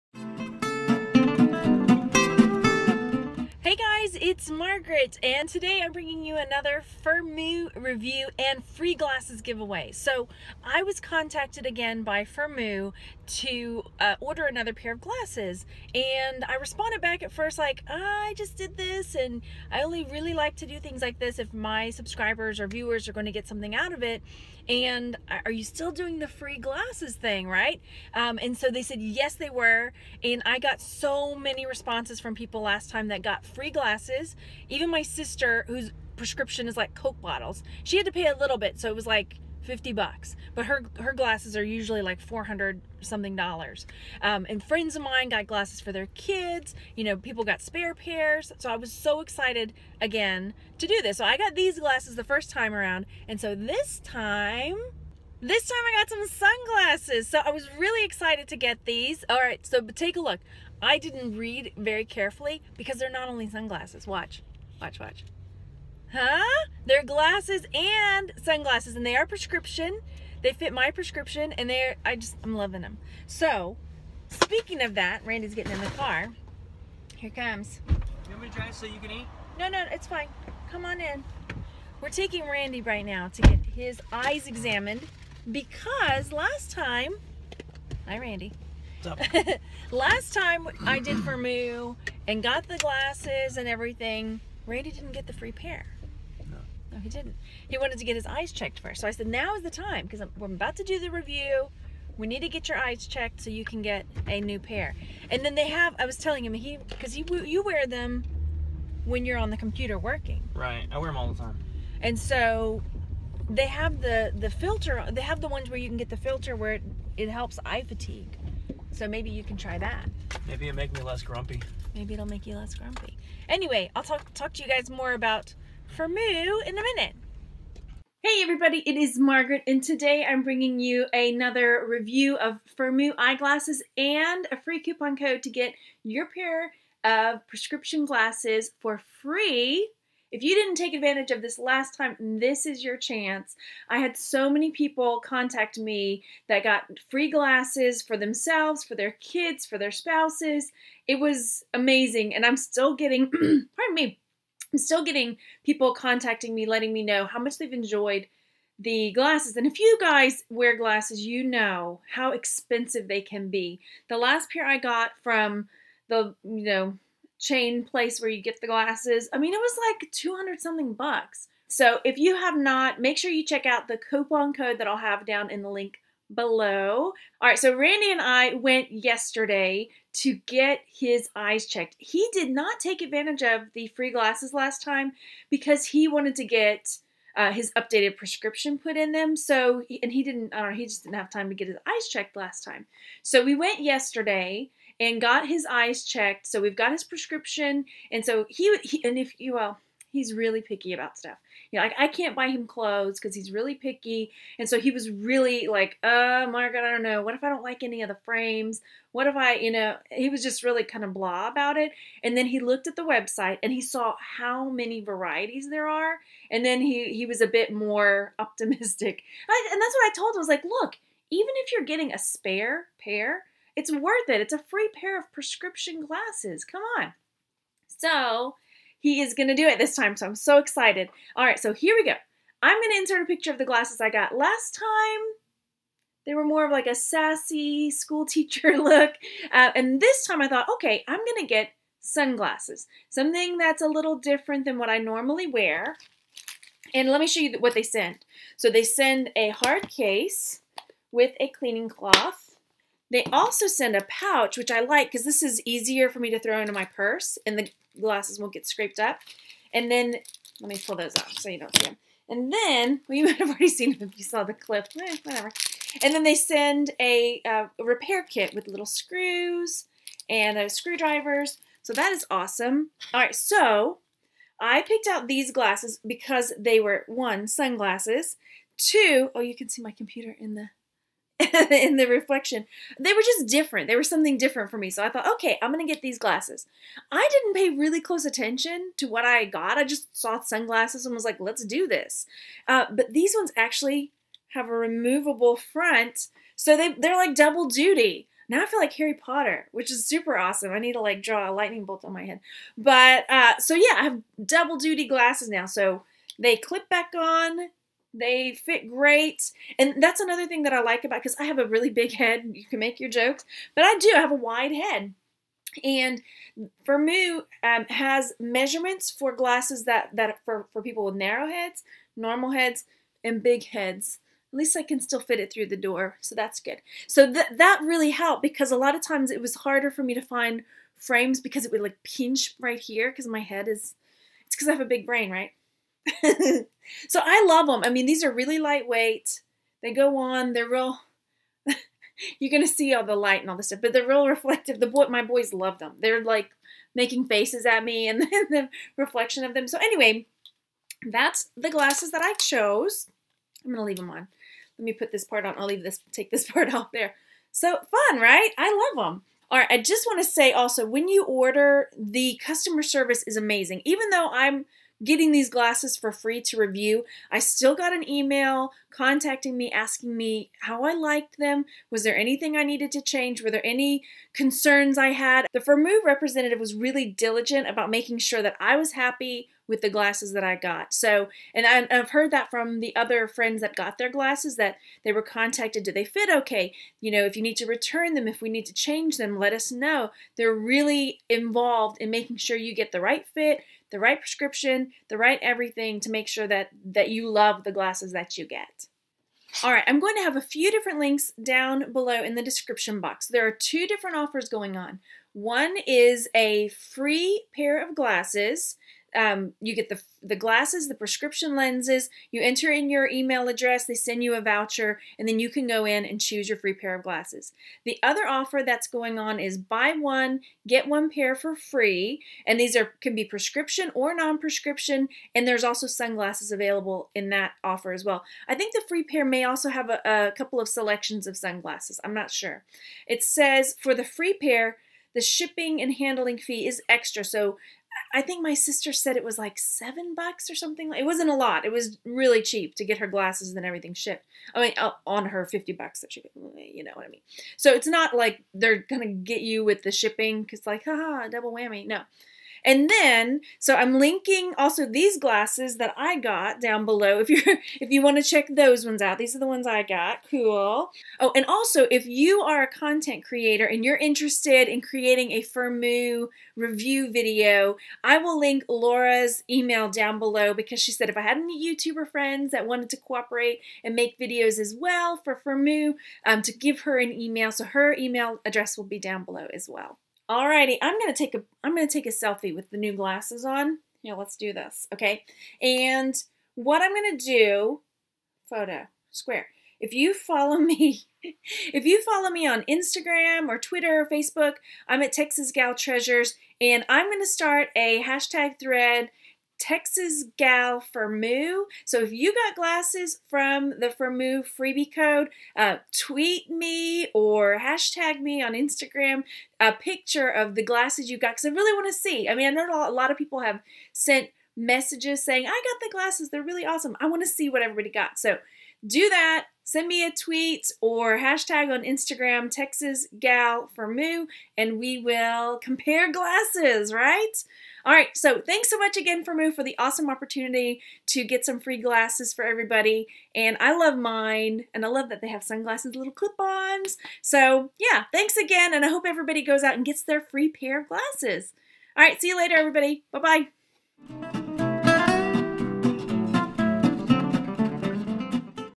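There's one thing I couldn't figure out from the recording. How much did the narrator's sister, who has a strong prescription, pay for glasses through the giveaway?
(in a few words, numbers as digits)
$50.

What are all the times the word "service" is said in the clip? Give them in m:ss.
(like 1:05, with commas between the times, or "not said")
6:02.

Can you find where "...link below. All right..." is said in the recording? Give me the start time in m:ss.
2:55.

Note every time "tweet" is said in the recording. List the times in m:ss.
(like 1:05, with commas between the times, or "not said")
8:25, 8:40.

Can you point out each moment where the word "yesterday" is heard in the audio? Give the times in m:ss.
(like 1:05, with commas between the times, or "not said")
2:58, 3:13.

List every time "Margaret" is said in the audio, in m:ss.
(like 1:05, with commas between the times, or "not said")
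0:04, 2:09.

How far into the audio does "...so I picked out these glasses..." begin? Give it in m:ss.
4:33.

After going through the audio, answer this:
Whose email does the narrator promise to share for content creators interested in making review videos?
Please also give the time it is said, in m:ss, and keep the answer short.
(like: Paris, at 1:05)
Laura, at 7:48.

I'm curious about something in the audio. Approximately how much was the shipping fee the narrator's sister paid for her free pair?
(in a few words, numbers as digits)
7 bucks.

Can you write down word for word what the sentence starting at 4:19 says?
And then, let me pull those off so you don't see them.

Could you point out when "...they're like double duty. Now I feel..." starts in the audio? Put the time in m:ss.
4:56.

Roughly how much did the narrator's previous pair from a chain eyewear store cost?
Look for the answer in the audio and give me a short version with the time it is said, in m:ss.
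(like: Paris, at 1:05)
200 something bucks, at 2:50.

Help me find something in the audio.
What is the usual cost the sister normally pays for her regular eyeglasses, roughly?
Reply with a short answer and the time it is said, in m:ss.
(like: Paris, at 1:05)
400 something dollars, at 0:42.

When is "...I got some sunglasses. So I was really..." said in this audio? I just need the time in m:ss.
0:55.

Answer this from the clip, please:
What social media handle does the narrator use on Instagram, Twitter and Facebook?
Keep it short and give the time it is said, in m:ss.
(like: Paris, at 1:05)
Texas Gal Treasures, at 8:15.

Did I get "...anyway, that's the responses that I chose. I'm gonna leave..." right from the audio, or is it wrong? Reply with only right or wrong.
wrong.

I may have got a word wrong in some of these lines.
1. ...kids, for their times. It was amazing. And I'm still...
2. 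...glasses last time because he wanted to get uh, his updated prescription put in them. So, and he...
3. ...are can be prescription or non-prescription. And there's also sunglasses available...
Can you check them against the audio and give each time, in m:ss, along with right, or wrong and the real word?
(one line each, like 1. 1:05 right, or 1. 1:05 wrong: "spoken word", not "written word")
1. 2:29 wrong: "spouses", not "times"
2. 3:04 right
3. 7:02 right.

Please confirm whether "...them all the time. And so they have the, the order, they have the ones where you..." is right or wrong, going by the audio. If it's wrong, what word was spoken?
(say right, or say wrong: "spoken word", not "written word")
wrong: "filter", not "order".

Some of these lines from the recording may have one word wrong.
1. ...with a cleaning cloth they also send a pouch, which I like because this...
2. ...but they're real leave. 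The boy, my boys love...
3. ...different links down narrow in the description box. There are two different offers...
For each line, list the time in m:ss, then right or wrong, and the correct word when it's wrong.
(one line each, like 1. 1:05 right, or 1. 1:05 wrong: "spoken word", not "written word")
1. 4:11 right
2. 5:43 wrong: "reflective", not "leave"
3. 6:40 wrong: "below", not "narrow".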